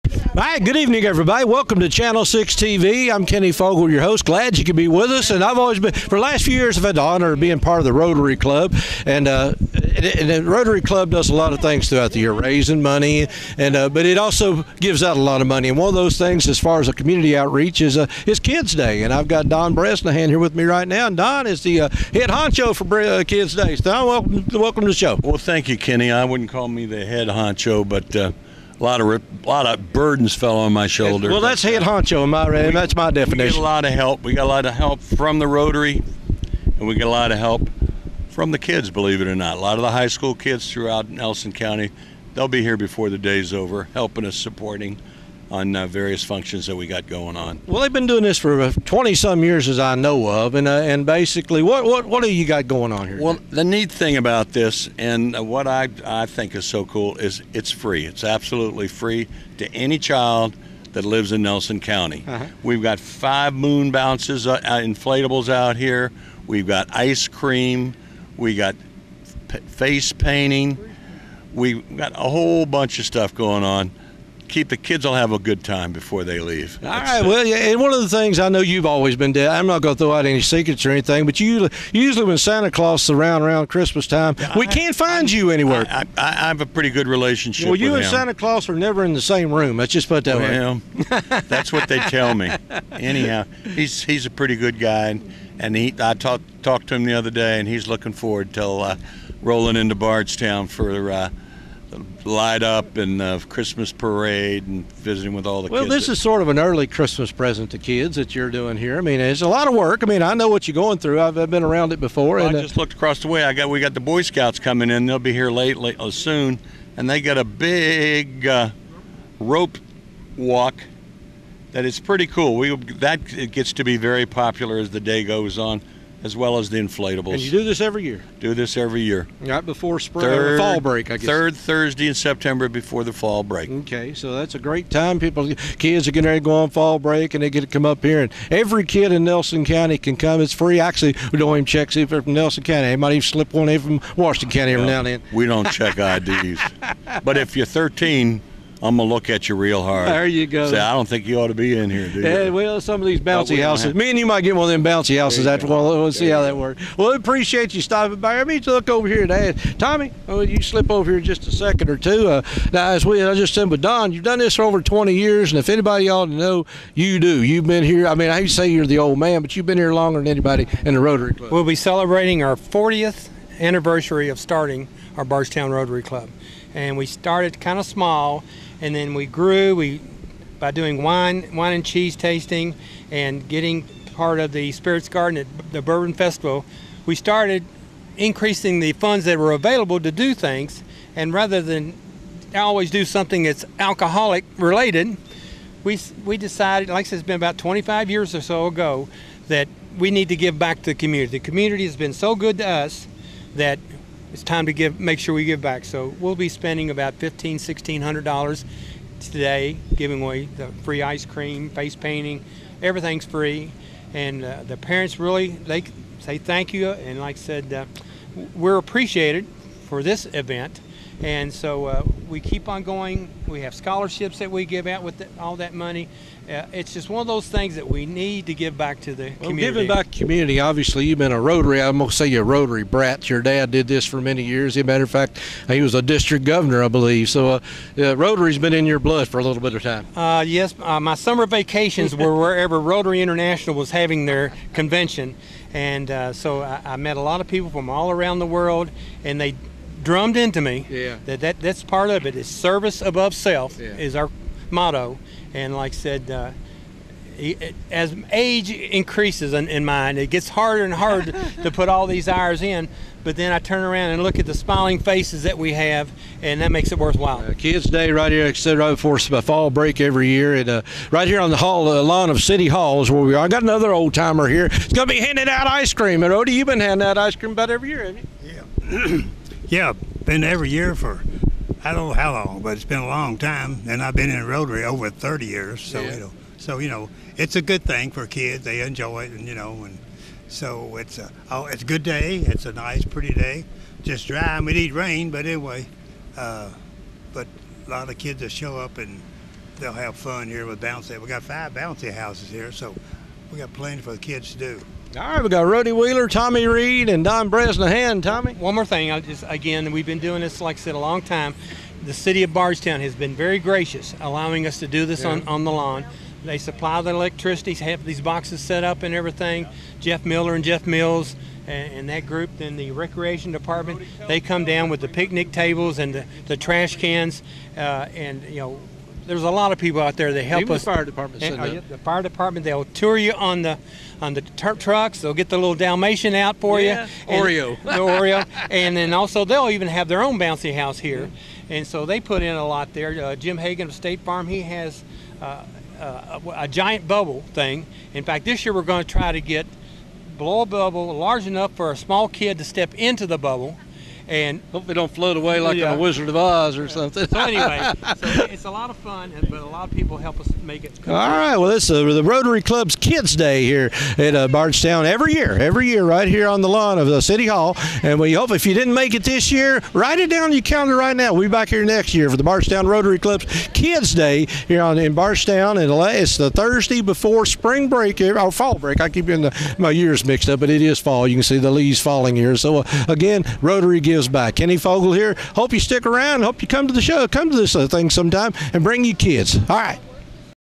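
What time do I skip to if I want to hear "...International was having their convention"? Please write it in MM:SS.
04:03.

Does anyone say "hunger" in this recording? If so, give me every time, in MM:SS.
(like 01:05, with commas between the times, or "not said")
not said.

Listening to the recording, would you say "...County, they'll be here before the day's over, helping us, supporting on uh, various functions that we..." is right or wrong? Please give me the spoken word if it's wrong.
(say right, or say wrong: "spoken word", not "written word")
right.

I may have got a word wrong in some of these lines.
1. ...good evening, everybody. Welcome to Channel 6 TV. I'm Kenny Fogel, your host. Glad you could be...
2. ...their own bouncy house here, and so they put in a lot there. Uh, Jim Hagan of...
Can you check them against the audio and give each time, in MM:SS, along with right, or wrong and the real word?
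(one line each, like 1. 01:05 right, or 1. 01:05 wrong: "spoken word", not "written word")
1. 00:00 right
2. 05:40 right.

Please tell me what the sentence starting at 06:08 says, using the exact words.
And we hope if you didn't make it this year, write it down on your calendar right now.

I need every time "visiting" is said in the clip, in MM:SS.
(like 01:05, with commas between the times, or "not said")
01:44.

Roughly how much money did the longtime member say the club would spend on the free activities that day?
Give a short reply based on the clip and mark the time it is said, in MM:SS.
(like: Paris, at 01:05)
$1,500-1,600, at 03:27.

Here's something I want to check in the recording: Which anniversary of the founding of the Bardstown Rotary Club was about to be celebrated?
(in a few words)
40th.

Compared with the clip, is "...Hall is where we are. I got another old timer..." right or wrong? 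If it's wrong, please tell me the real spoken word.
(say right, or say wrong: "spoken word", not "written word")
right.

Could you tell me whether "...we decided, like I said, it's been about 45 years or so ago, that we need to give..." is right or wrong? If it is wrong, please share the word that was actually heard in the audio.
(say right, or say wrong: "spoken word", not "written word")
wrong: "25", not "45".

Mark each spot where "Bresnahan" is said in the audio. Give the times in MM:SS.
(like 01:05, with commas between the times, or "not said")
00:19, 05:07.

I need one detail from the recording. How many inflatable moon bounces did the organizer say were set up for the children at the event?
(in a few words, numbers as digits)
5.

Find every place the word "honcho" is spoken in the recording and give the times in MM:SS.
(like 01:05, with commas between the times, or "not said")
00:22, 00:27, 00:31.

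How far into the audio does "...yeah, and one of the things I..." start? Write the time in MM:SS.
01:17.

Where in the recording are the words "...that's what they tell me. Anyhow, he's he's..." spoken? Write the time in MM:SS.
01:31.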